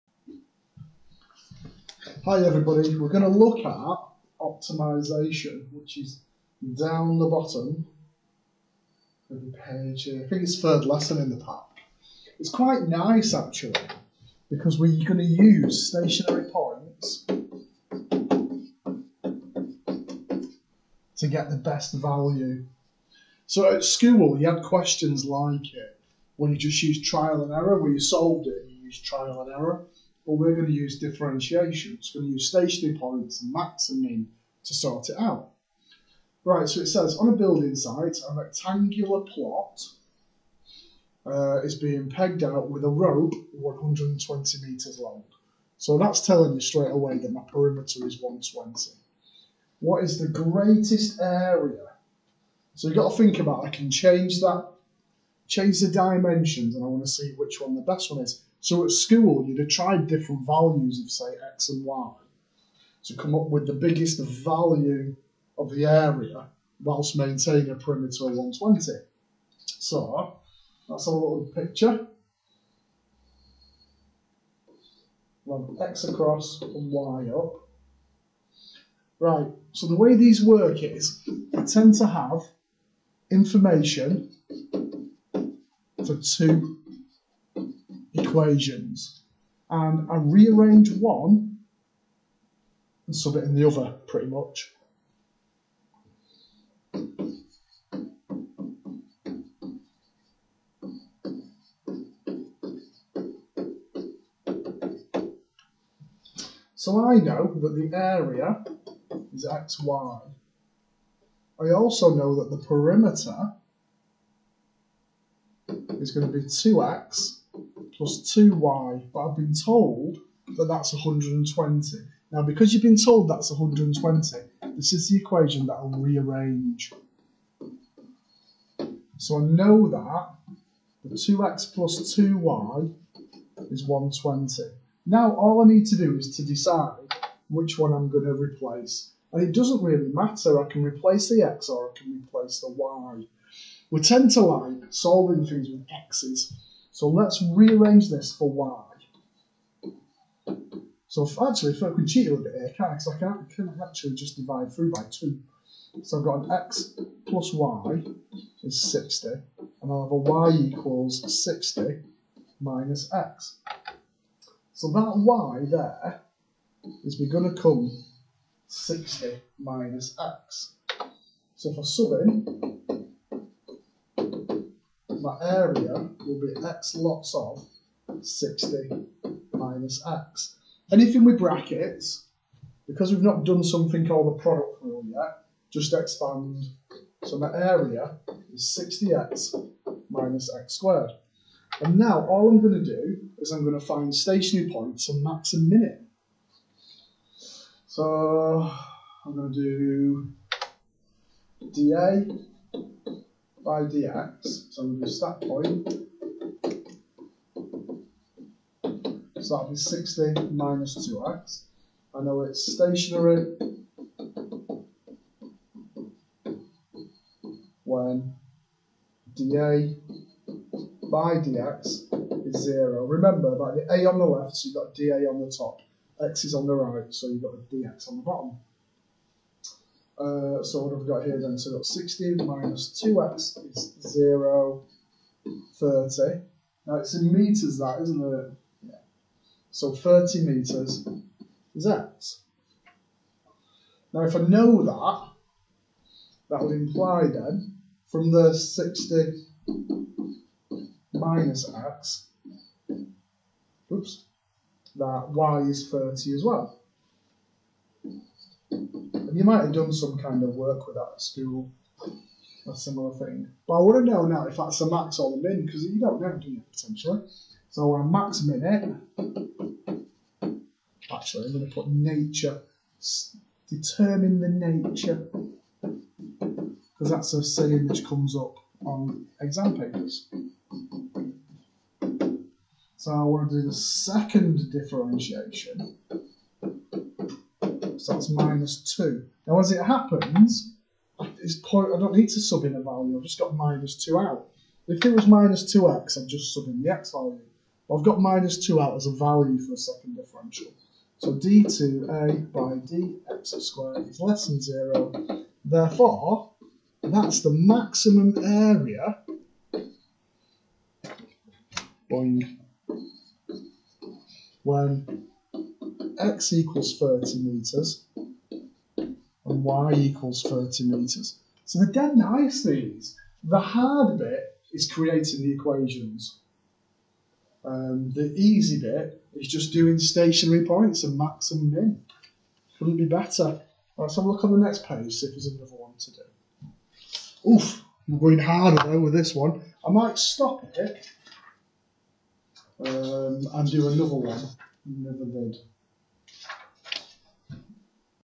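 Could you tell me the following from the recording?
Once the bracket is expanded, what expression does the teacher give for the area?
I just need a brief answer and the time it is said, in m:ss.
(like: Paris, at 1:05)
60x minus x squared, at 3:08.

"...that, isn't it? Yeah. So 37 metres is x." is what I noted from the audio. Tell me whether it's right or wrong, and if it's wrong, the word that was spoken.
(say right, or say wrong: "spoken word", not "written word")
wrong: "30", not "37".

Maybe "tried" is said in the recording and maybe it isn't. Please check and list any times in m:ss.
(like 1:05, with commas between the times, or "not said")
0:59.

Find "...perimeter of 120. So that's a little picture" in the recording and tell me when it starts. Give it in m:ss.
1:07.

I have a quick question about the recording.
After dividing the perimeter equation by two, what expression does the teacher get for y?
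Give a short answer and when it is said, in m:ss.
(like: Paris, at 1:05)
60 minus x, at 2:40.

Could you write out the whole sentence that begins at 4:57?
But I've got minus 2 out as a value for a second differential.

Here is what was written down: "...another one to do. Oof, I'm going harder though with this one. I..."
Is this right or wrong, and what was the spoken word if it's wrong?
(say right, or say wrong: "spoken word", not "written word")
right.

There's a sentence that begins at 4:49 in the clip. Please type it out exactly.
Now, as it happens, it's I don't need to sub in a value, I've just got minus 2 out.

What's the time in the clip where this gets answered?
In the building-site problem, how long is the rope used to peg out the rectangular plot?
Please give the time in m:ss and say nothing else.
0:43.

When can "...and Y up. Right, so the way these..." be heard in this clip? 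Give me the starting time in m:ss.
1:16.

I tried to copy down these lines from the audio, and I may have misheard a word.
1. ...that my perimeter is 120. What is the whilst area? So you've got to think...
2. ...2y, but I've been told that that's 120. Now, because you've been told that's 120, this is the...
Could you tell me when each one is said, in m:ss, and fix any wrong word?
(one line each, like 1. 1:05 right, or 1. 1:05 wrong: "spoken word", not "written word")
1. 0:47 wrong: "greatest", not "whilst"
2. 1:58 right.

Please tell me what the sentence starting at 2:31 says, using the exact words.
So if, actually, if I can cheat a little bit here, can I?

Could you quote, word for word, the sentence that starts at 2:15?
Now, all I need to do is to decide which one I'm going to replace.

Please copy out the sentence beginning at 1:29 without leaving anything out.
And I rearrange one and sub it in the other, pretty much.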